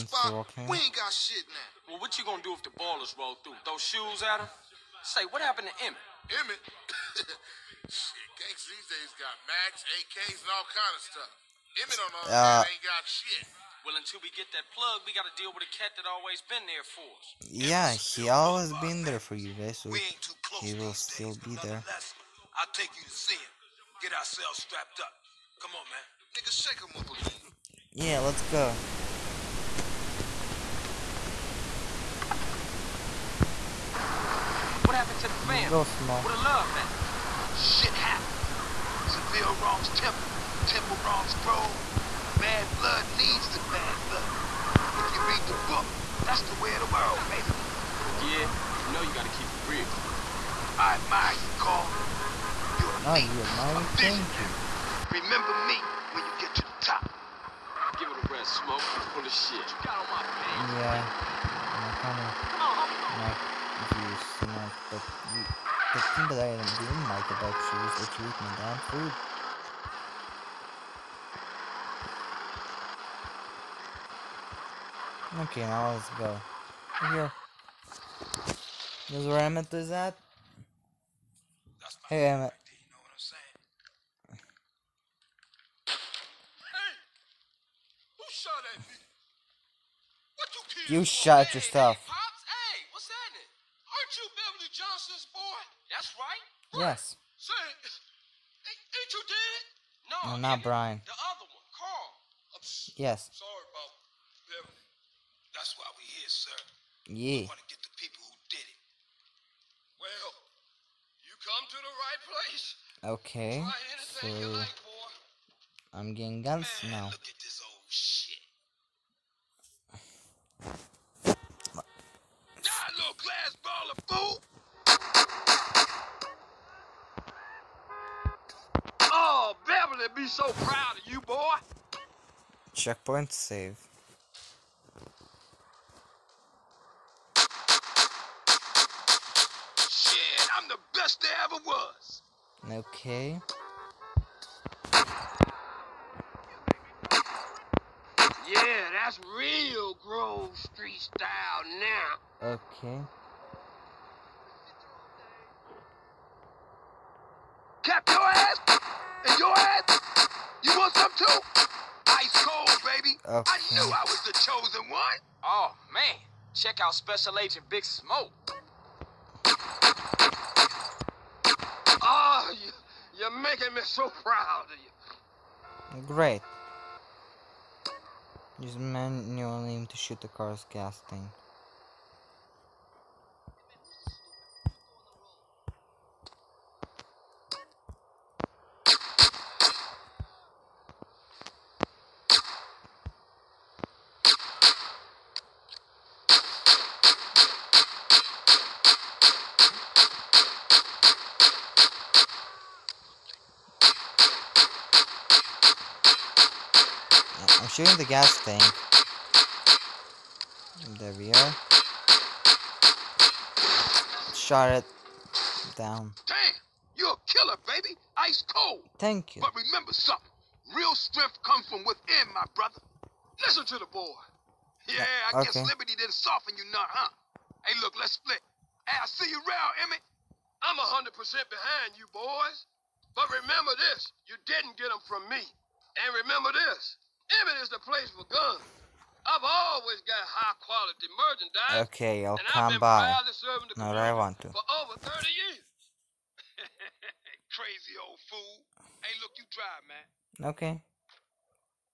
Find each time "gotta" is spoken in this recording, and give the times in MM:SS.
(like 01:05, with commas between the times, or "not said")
00:15, 00:49.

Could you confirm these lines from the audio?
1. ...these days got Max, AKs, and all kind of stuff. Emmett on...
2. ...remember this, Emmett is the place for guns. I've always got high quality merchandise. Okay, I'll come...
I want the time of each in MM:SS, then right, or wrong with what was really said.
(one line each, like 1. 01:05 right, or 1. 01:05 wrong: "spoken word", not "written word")
1. 00:08 right
2. 03:56 right.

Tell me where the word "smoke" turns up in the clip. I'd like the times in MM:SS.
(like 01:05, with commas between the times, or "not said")
00:58, 02:47.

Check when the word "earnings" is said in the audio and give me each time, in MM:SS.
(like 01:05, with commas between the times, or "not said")
not said.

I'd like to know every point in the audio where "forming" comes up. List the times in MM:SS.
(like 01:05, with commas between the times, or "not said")
not said.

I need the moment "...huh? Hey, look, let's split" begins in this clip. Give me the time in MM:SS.
03:46.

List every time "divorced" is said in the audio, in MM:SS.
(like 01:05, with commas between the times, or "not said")
not said.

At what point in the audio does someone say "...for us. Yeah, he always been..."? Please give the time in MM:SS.
00:16.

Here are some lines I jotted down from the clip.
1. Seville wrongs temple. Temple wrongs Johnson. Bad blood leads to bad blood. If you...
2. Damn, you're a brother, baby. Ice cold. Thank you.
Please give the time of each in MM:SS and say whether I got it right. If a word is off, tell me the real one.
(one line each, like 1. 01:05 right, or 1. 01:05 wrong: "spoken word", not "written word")
1. 00:39 wrong: "Grove", not "Johnson"
2. 03:36 wrong: "killer", not "brother".